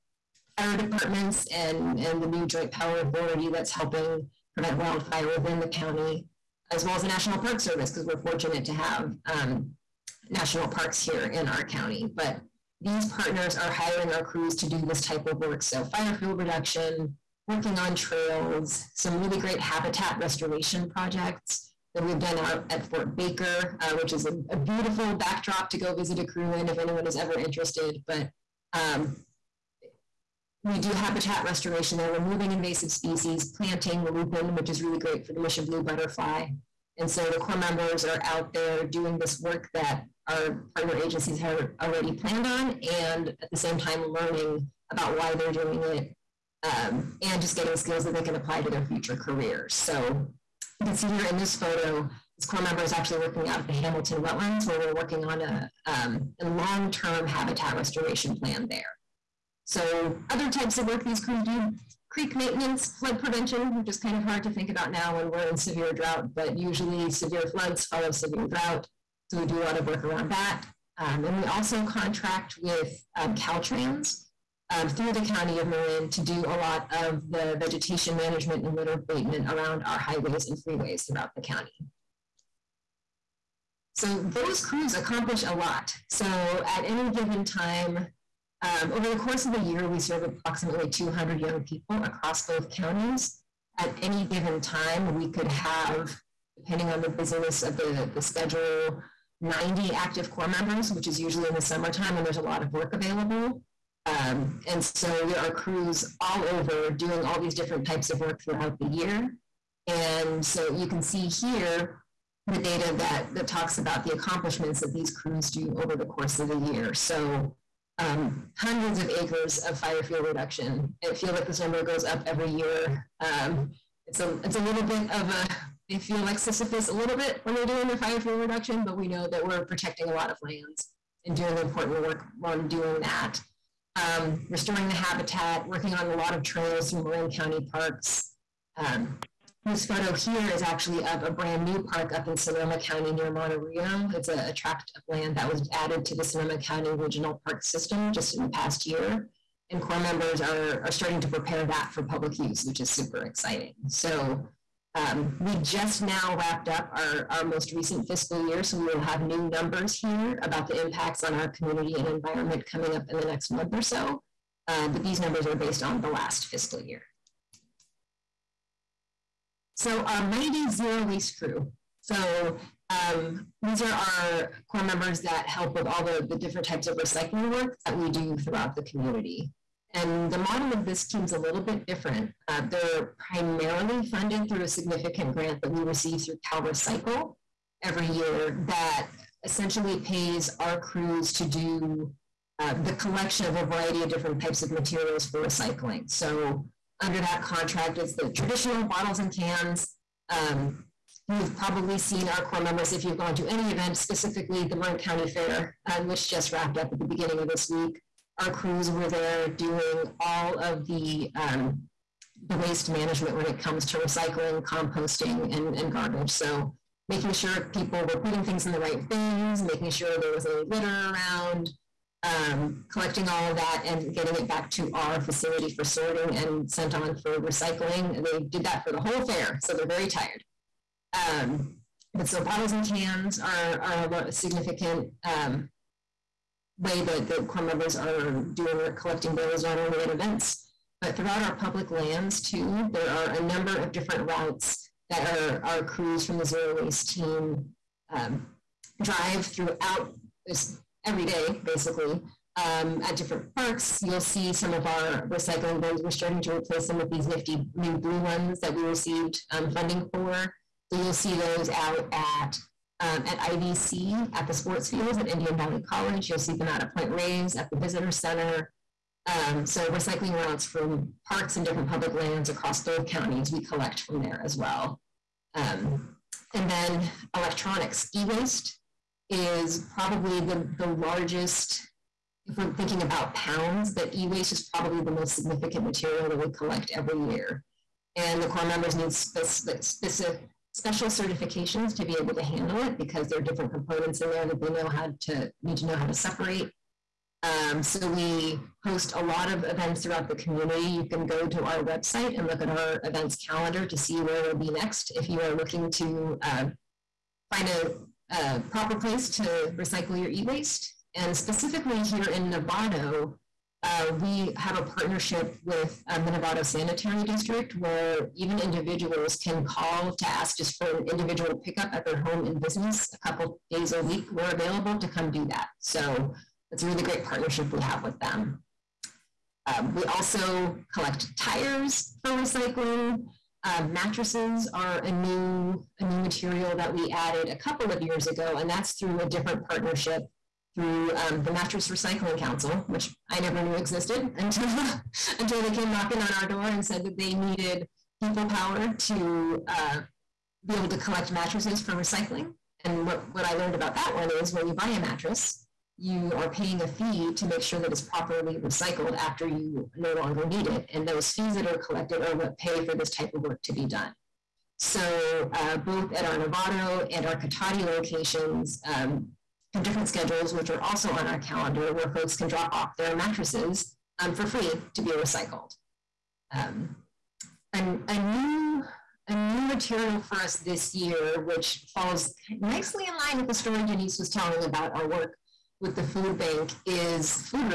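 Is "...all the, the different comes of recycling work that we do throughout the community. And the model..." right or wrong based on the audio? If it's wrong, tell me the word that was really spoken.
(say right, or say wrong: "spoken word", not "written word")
wrong: "types", not "comes".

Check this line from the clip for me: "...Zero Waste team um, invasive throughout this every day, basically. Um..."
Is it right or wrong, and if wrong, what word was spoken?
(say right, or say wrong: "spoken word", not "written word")
wrong: "drive", not "invasive".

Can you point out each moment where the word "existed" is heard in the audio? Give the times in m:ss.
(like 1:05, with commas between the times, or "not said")
5:43.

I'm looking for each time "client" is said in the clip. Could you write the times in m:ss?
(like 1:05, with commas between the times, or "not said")
not said.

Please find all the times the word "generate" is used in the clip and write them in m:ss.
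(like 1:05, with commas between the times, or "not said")
not said.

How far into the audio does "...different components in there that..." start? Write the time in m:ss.
4:53.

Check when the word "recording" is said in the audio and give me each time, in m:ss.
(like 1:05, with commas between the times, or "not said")
not said.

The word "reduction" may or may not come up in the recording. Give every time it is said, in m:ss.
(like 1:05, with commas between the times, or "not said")
0:16, 2:00, 2:08.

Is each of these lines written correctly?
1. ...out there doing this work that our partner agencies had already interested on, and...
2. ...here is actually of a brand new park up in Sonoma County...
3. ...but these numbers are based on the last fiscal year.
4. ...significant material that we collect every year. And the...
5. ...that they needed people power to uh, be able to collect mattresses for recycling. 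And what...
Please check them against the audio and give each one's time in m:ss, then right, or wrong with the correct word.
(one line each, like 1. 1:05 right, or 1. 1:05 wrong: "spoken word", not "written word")
1. 0:38 wrong: "planned", not "interested"
2. 2:20 right
3. 2:44 right
4. 4:45 right
5. 5:47 right.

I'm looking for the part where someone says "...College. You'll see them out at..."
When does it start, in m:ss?
4:25.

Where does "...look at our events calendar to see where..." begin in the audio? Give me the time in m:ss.
5:02.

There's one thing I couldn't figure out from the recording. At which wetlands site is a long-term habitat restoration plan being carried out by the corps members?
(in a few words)
Hamilton Wetlands.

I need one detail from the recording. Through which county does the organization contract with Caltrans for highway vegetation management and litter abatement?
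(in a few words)
County of Marin.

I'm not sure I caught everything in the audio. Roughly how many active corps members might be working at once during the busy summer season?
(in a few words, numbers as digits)
90.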